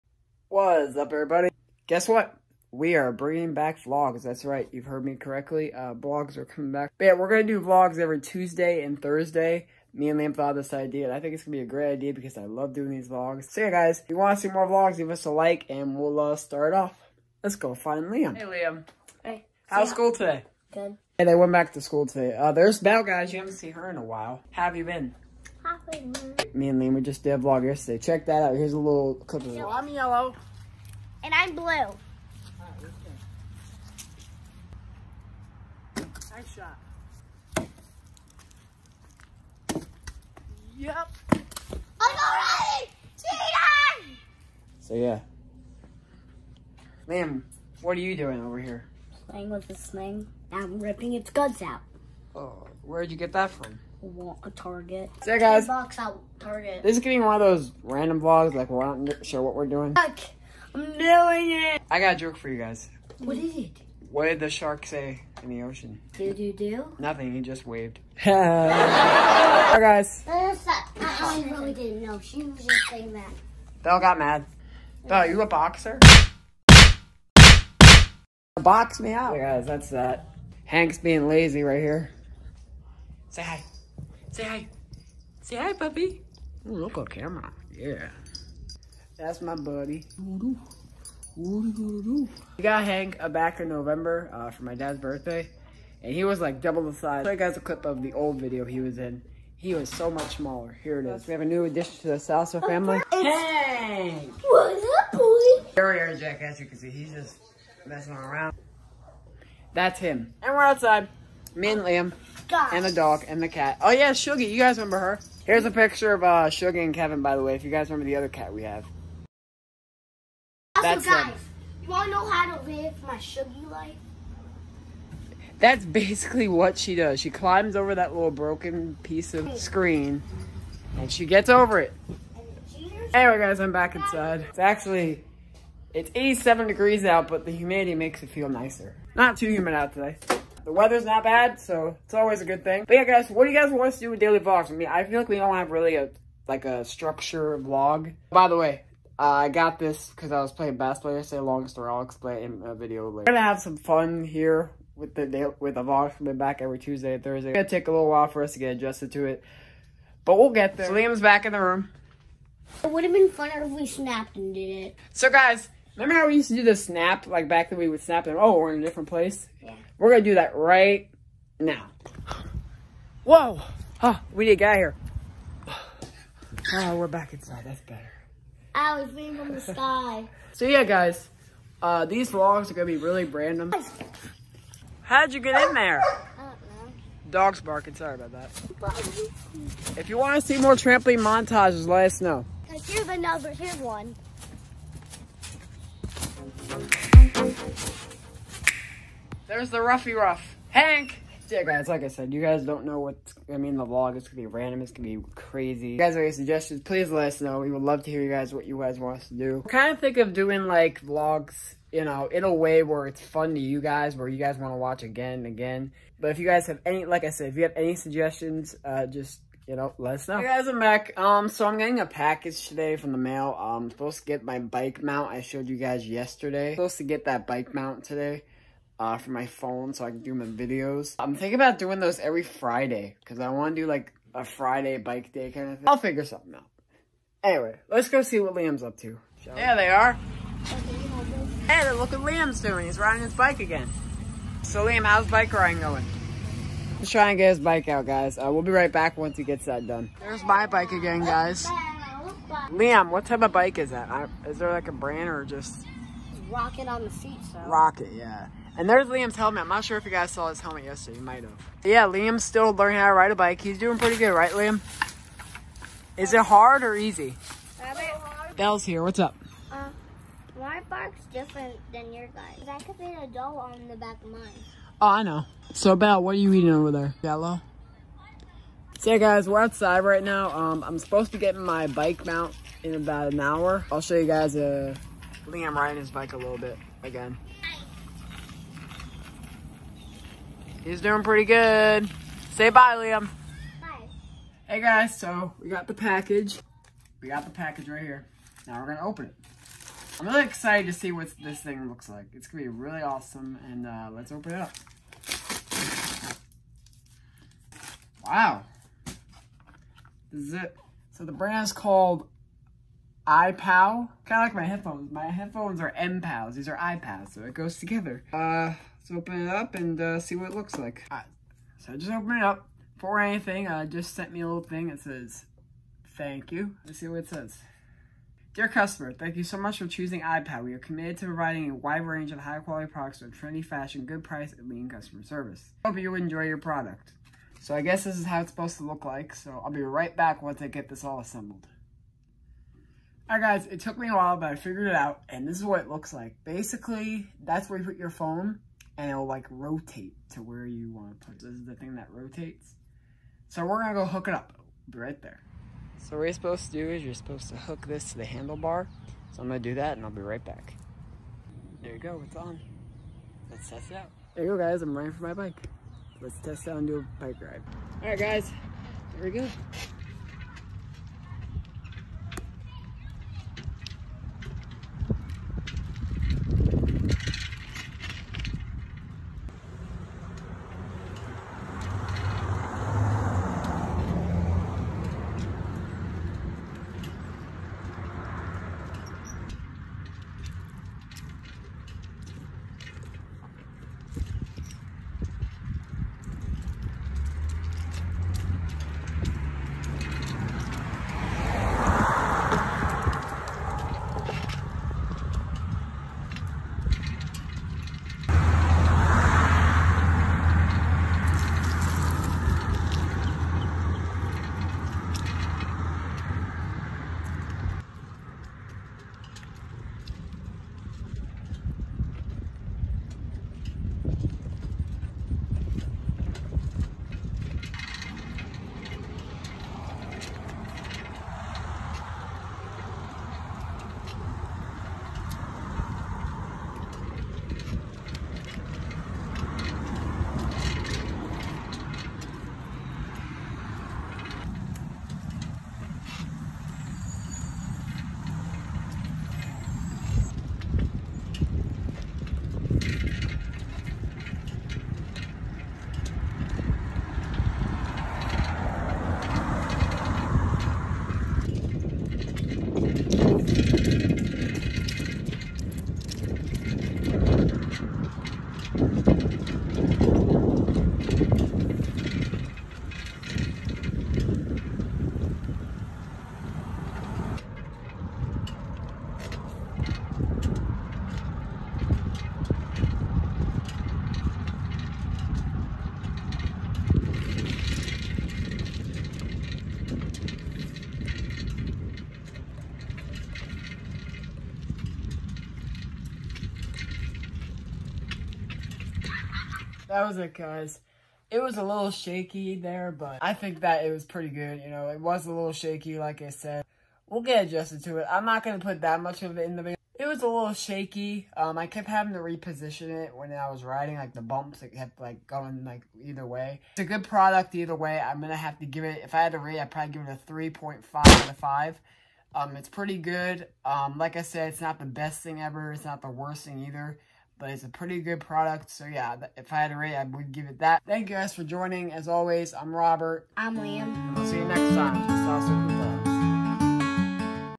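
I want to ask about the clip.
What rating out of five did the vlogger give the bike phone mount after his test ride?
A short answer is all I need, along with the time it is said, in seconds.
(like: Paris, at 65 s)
3.5, at 520 s.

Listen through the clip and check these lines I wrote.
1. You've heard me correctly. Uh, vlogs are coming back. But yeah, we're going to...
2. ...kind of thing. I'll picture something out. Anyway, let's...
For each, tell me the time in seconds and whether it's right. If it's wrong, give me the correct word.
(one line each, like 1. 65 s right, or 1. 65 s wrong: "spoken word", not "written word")
1. 4 s right
2. 235 s wrong: "figure", not "picture".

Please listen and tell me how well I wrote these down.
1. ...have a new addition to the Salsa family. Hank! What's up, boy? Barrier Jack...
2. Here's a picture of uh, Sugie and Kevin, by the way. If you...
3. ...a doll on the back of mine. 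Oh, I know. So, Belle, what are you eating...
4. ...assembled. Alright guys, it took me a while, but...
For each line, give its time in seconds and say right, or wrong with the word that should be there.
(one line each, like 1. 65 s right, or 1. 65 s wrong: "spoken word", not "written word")
1. 101 s right
2. 115 s right
3. 273 s right
4. 341 s right.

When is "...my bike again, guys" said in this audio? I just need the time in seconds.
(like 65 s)
250 s.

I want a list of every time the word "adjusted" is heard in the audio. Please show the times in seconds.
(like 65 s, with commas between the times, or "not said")
158 s, 507 s.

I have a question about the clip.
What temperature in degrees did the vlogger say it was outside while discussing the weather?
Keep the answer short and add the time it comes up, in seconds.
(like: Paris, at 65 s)
87 degrees, at 136 s.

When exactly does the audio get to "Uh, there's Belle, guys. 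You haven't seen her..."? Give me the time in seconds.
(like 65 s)
22 s.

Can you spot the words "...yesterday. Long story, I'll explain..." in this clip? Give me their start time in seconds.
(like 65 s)
151 s.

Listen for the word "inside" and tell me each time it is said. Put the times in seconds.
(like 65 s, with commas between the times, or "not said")
133 s, 177 s.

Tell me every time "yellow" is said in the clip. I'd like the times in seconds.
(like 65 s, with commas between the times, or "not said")
29 s, 277 s.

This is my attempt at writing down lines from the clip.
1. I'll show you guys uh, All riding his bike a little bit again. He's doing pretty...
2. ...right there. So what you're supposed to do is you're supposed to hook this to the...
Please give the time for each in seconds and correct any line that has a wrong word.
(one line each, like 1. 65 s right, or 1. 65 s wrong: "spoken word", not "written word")
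1. 283 s wrong: "Liam", not "All"
2. 354 s right.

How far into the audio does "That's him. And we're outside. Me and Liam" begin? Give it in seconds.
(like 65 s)
109 s.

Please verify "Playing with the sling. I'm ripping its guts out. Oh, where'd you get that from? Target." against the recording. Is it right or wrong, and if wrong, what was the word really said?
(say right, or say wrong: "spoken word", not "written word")
right.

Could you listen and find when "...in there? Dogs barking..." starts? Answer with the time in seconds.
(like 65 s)
185 s.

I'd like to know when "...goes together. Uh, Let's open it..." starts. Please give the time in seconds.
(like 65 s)
317 s.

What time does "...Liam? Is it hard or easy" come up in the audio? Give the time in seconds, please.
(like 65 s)
264 s.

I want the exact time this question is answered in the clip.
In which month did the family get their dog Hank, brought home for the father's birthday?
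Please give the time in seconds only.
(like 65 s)
93 s.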